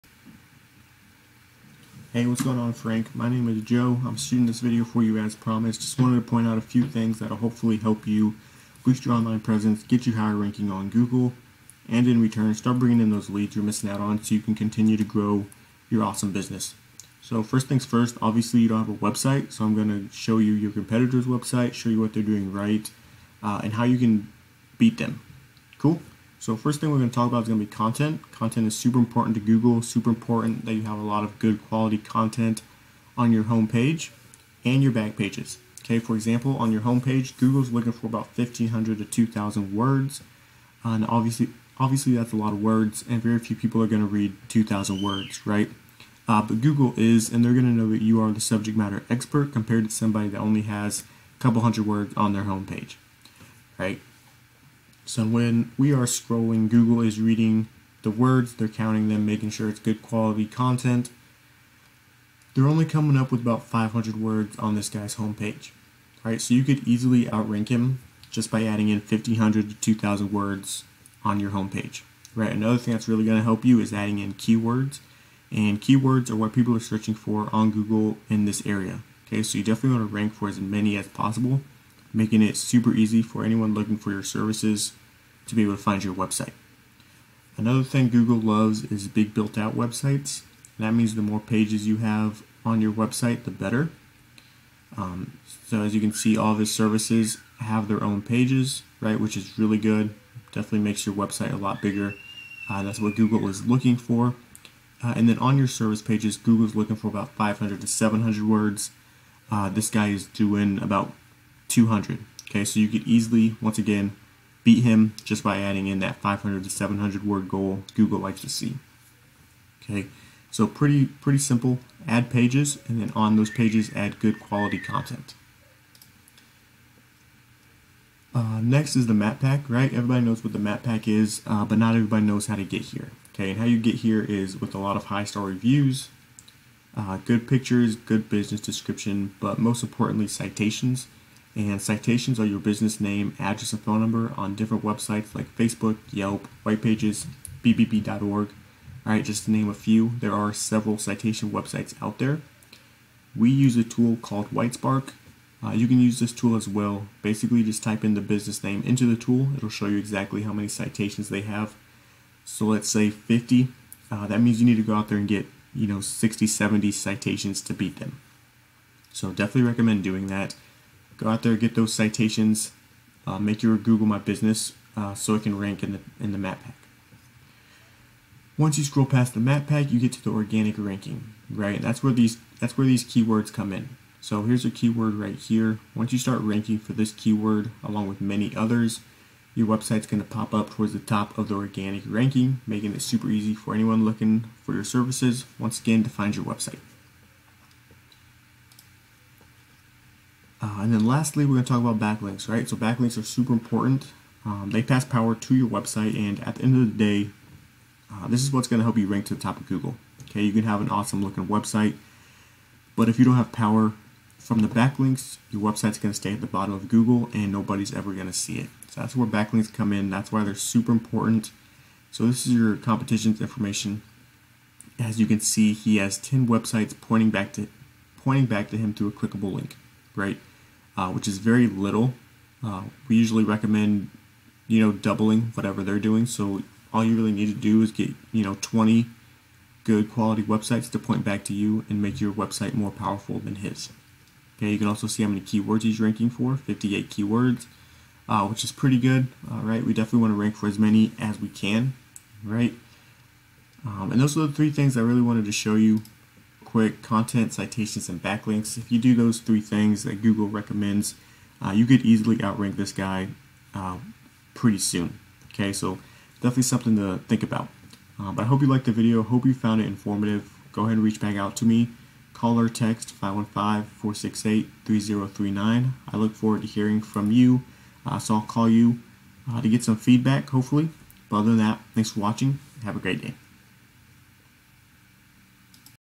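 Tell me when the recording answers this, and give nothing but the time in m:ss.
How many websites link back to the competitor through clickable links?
3:46.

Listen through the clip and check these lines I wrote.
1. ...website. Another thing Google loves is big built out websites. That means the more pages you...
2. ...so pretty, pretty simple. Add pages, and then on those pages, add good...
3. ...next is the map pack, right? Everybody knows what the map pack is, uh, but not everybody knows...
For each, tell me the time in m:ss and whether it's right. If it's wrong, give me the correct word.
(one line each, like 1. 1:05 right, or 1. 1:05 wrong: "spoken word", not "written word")
1. 1:26 right
2. 2:00 right
3. 2:08 right.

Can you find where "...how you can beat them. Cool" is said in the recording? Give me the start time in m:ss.
0:23.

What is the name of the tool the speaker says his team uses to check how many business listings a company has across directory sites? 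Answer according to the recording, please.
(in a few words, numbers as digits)
Whitespark.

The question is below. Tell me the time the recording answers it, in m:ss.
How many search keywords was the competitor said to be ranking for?
4:06.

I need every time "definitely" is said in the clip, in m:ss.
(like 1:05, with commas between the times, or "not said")
1:19, 1:40, 2:49, 4:09, 4:26.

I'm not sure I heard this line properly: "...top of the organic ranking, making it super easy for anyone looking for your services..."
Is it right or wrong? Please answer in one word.
right.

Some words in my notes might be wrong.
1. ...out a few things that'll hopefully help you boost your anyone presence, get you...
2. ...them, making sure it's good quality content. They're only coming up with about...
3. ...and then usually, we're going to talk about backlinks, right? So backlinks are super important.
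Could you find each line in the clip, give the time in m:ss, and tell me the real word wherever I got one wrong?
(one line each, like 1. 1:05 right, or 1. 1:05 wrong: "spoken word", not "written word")
1. 0:06 wrong: "online", not "anyone"
2. 0:59 right
3. 3:20 wrong: "lastly", not "usually".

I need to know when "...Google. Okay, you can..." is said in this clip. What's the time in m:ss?
3:29.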